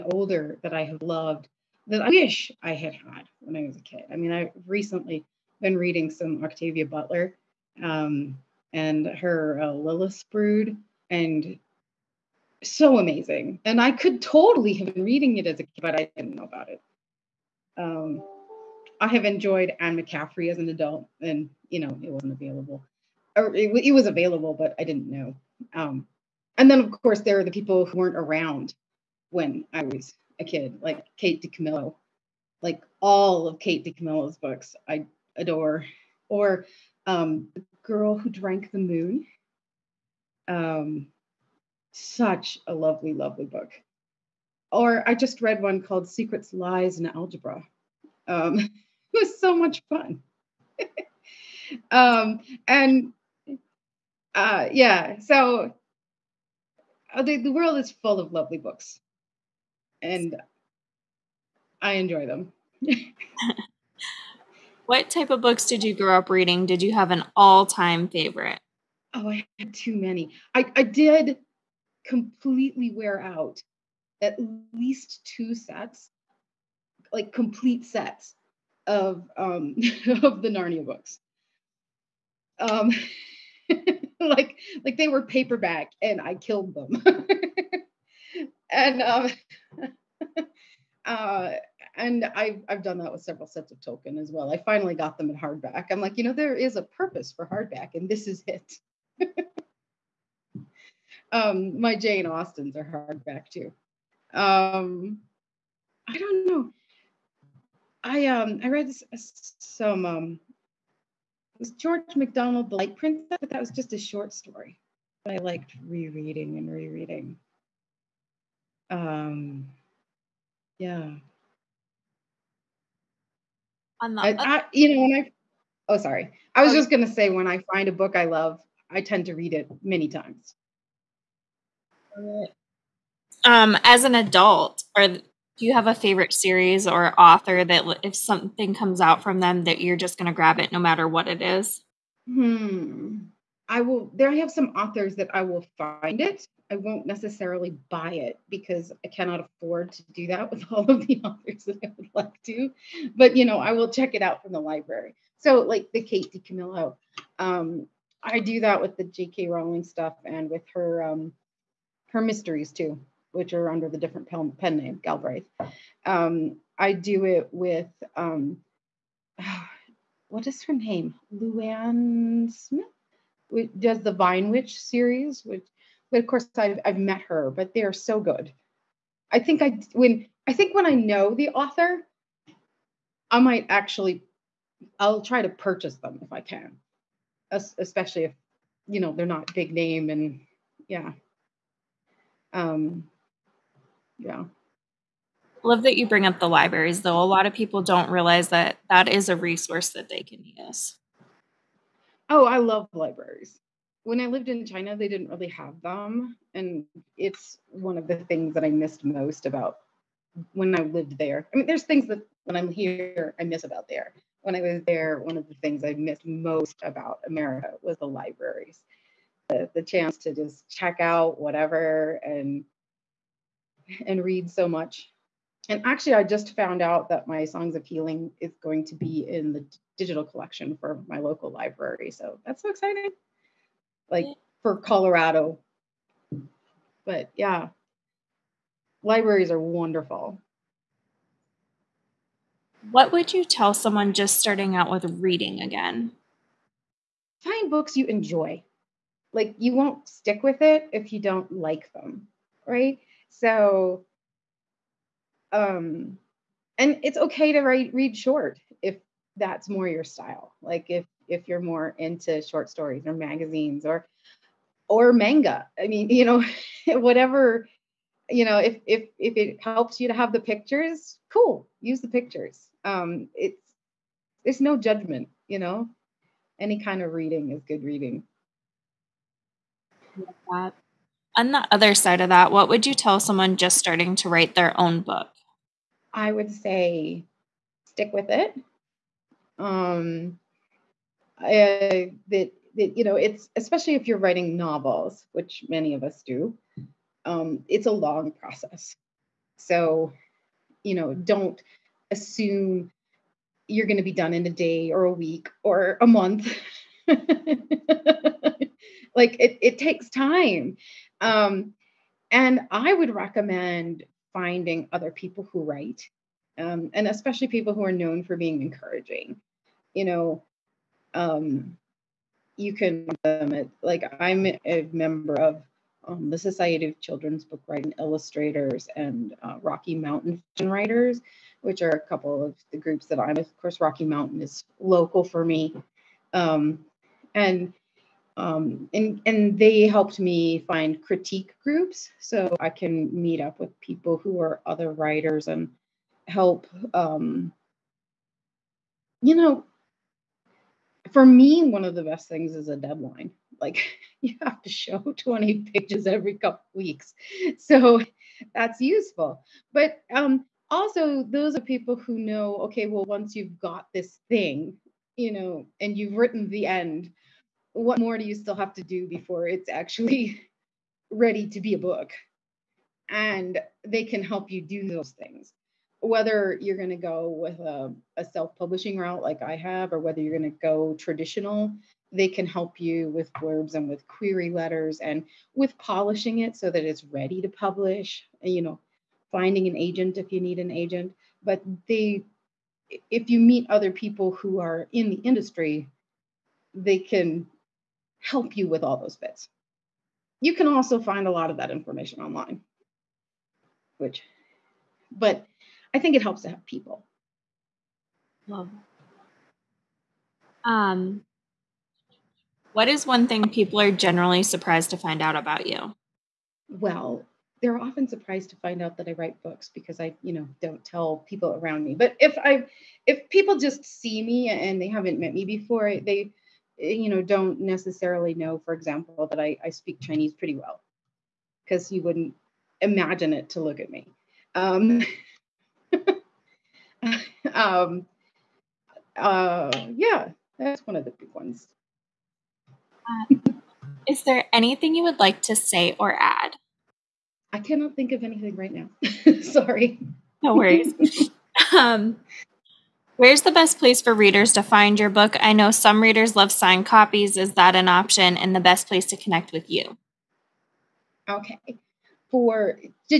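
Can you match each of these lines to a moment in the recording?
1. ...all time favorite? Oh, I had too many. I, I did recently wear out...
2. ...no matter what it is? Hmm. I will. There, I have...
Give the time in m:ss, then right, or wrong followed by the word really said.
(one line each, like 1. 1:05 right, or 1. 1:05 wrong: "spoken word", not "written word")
1. 1:07 wrong: "completely", not "recently"
2. 2:20 right.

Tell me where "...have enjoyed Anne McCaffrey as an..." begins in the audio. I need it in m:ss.
0:19.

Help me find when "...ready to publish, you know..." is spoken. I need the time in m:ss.
6:27.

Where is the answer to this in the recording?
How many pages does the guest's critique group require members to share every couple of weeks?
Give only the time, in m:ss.
5:55.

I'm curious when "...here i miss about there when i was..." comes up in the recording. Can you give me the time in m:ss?
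3:32.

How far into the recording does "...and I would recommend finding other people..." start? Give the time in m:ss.
5:12.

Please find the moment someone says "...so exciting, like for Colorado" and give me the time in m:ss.
3:52.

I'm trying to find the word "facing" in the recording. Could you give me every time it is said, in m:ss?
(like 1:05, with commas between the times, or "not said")
not said.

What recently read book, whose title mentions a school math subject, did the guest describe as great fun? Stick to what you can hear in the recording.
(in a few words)
Secrets, Lies, and Algebra.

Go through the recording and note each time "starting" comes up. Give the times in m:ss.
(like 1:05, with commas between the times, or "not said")
4:04, 4:43.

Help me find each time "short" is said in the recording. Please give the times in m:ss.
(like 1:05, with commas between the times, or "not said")
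1:53, 4:18, 4:22.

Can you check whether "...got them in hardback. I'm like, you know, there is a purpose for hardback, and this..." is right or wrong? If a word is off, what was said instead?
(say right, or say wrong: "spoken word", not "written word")
right.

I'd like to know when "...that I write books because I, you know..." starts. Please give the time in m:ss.
6:58.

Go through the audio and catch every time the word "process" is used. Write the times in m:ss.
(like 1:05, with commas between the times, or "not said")
4:58.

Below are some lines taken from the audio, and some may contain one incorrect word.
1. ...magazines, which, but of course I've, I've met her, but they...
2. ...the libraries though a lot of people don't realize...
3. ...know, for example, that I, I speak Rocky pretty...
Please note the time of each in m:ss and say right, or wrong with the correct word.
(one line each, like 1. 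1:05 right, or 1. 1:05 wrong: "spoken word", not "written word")
1. 2:54 wrong: "series", not "magazines"
2. 3:16 right
3. 7:08 wrong: "Chinese", not "Rocky".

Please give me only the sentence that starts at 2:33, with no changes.
But you know, I will check it out from the library.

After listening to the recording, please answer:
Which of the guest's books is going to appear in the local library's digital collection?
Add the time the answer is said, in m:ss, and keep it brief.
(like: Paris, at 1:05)
Songs of Healing, at 3:47.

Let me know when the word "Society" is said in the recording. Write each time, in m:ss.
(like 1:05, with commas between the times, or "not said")
5:26.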